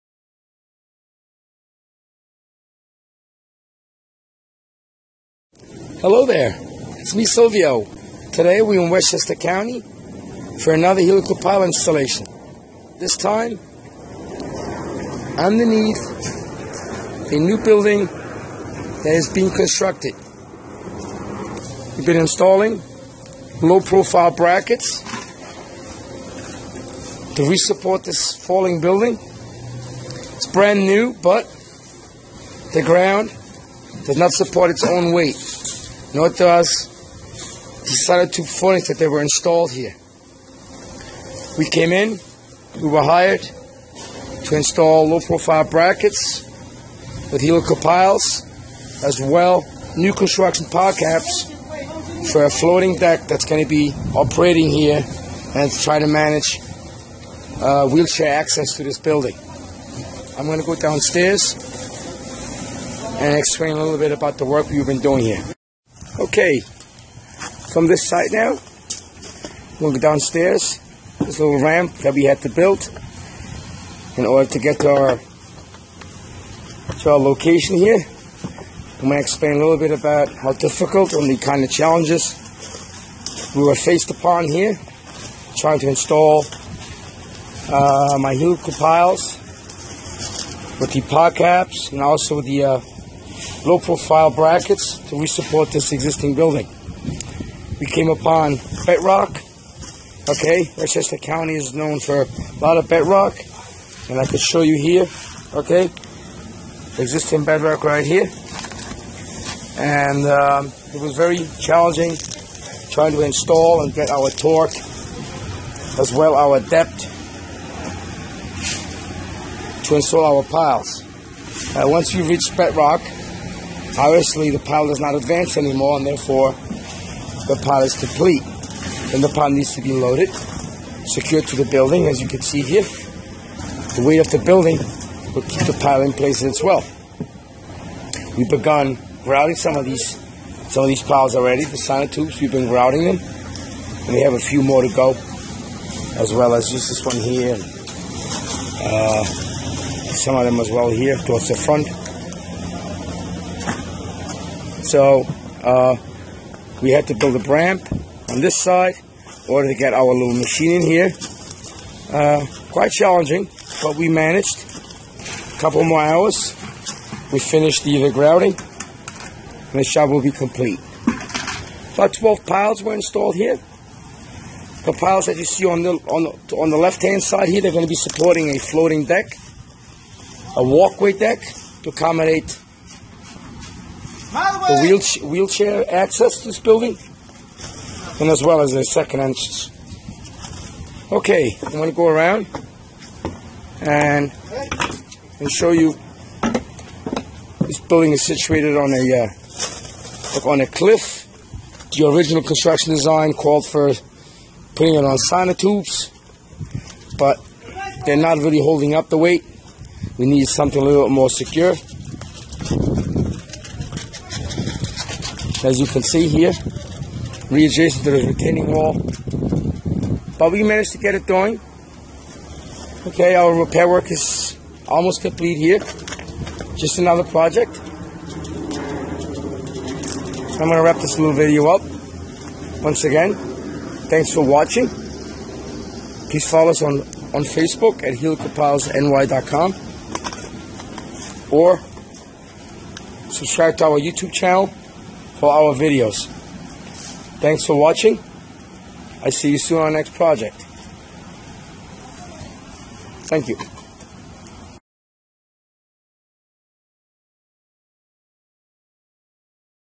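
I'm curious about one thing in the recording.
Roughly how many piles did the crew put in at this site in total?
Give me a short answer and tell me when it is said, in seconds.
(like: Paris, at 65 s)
12, at 172 s.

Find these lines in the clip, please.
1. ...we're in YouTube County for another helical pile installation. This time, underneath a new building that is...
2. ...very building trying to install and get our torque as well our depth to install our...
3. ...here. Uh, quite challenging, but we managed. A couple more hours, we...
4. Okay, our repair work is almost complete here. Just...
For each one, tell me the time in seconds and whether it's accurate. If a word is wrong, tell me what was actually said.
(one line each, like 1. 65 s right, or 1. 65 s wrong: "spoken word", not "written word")
1. 8 s wrong: "Westchester", not "YouTube"
2. 111 s wrong: "challenging", not "building"
3. 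160 s right
4. 223 s right.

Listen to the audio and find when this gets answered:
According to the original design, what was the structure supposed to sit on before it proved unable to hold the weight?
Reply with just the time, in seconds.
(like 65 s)
205 s.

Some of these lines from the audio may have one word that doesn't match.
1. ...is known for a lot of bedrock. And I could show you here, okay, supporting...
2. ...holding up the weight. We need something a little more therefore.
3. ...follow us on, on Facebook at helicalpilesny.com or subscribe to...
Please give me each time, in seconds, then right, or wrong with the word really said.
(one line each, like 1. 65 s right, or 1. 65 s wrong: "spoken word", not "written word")
1. 101 s wrong: "existing", not "supporting"
2. 208 s wrong: "secure", not "therefore"
3. 236 s right.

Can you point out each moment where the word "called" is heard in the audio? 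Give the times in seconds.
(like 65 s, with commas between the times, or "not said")
203 s.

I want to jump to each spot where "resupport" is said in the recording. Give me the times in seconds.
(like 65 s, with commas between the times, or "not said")
27 s, 95 s.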